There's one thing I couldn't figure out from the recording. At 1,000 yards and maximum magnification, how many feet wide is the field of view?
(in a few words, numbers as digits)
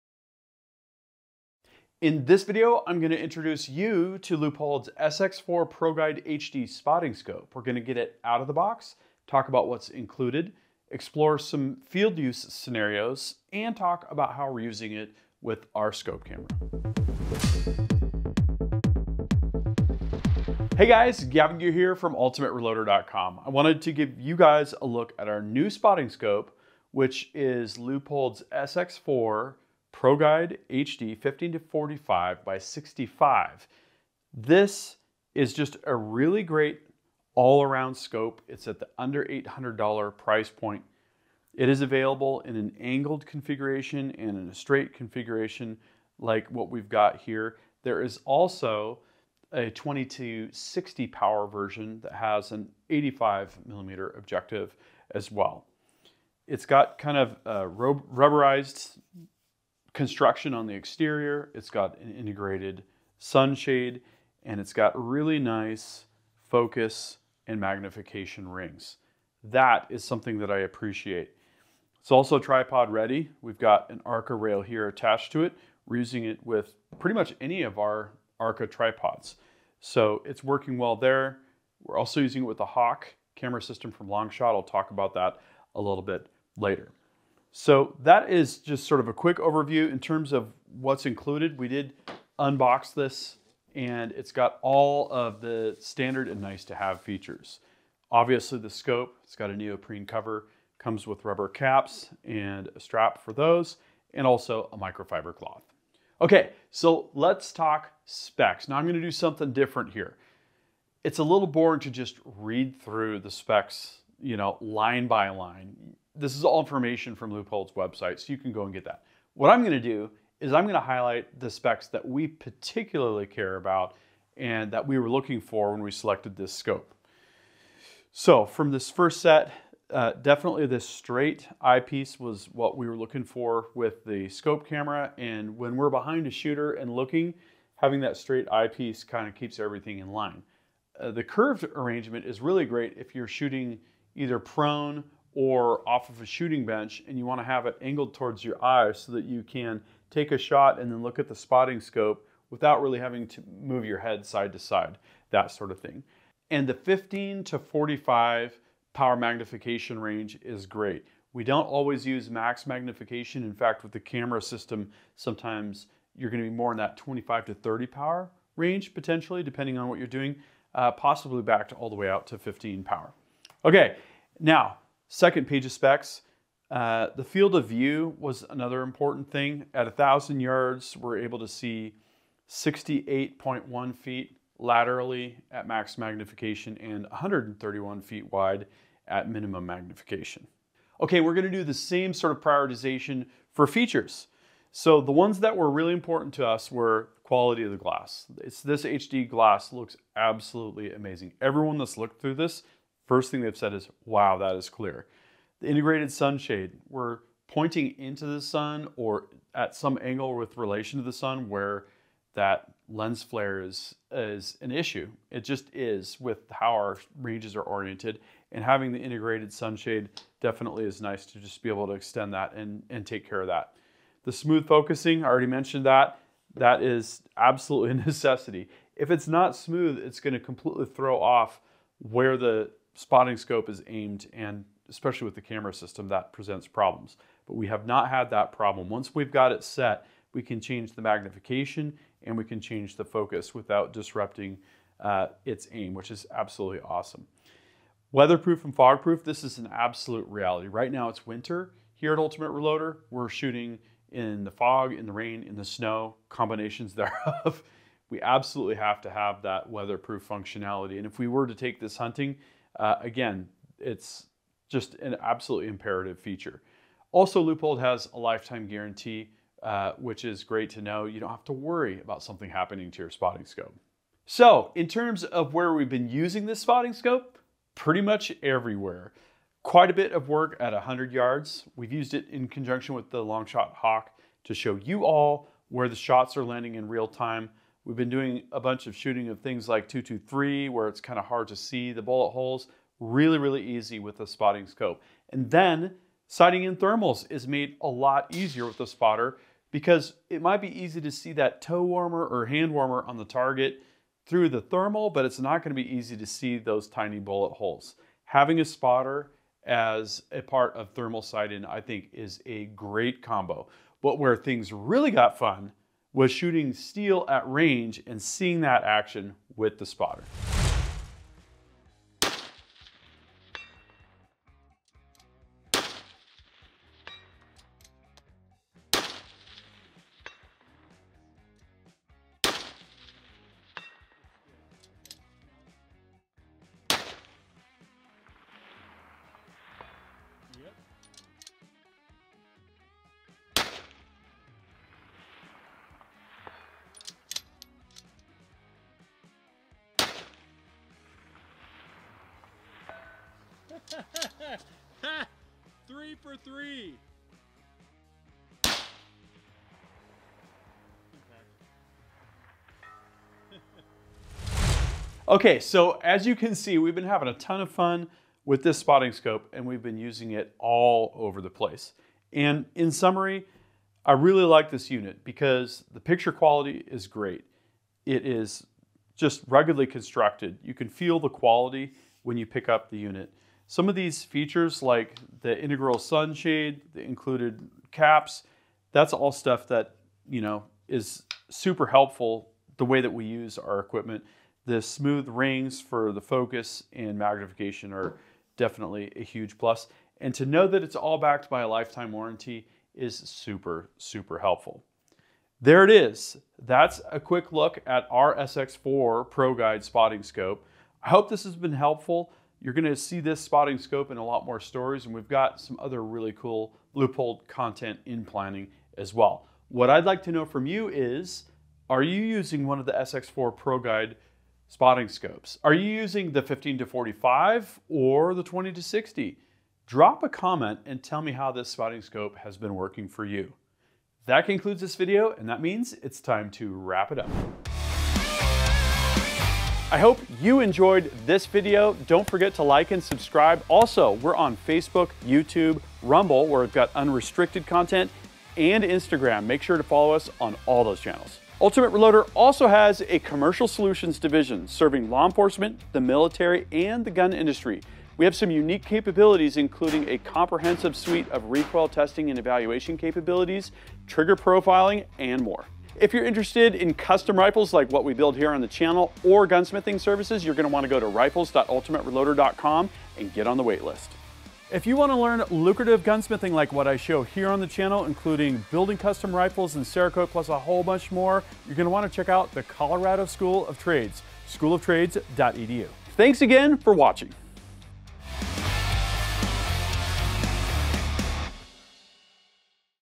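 68.1 feet.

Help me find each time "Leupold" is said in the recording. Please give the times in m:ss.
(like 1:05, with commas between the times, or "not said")
0:04, 0:27, 1:57, 4:27, 6:56.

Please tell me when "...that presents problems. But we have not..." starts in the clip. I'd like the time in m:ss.
3:56.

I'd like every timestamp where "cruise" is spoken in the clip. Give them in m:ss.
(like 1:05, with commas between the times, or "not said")
not said.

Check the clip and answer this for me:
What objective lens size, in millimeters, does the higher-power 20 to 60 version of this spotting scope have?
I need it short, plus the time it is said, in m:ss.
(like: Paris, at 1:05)
85, at 0:52.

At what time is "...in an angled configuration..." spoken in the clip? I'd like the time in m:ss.
0:42.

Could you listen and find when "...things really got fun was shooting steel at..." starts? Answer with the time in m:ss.
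5:14.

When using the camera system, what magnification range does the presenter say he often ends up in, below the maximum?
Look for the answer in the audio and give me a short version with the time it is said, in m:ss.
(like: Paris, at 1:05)
25 to 30 power, at 2:46.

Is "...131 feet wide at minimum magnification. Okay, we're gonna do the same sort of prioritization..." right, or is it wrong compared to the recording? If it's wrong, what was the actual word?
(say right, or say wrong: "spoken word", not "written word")
right.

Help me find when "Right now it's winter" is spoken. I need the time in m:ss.
4:10.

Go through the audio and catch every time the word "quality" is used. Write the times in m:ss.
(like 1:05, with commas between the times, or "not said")
3:17, 6:16, 6:21.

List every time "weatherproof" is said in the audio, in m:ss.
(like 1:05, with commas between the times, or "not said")
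4:08, 4:19.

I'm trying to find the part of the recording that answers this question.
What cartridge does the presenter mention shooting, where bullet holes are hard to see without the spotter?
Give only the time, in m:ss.
4:49.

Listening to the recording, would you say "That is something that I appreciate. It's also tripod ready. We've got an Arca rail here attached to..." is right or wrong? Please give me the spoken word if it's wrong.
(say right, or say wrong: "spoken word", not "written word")
right.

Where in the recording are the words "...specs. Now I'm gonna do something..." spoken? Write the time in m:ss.
1:48.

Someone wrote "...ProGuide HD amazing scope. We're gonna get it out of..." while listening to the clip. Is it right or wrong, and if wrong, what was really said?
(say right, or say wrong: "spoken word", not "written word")
wrong: "spotting", not "amazing".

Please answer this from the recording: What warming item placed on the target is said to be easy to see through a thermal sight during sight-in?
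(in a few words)
toe warmer.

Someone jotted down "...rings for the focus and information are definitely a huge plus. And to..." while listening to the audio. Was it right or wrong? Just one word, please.
wrong.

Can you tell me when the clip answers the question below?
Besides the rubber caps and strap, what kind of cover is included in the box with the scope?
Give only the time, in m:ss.
1:39.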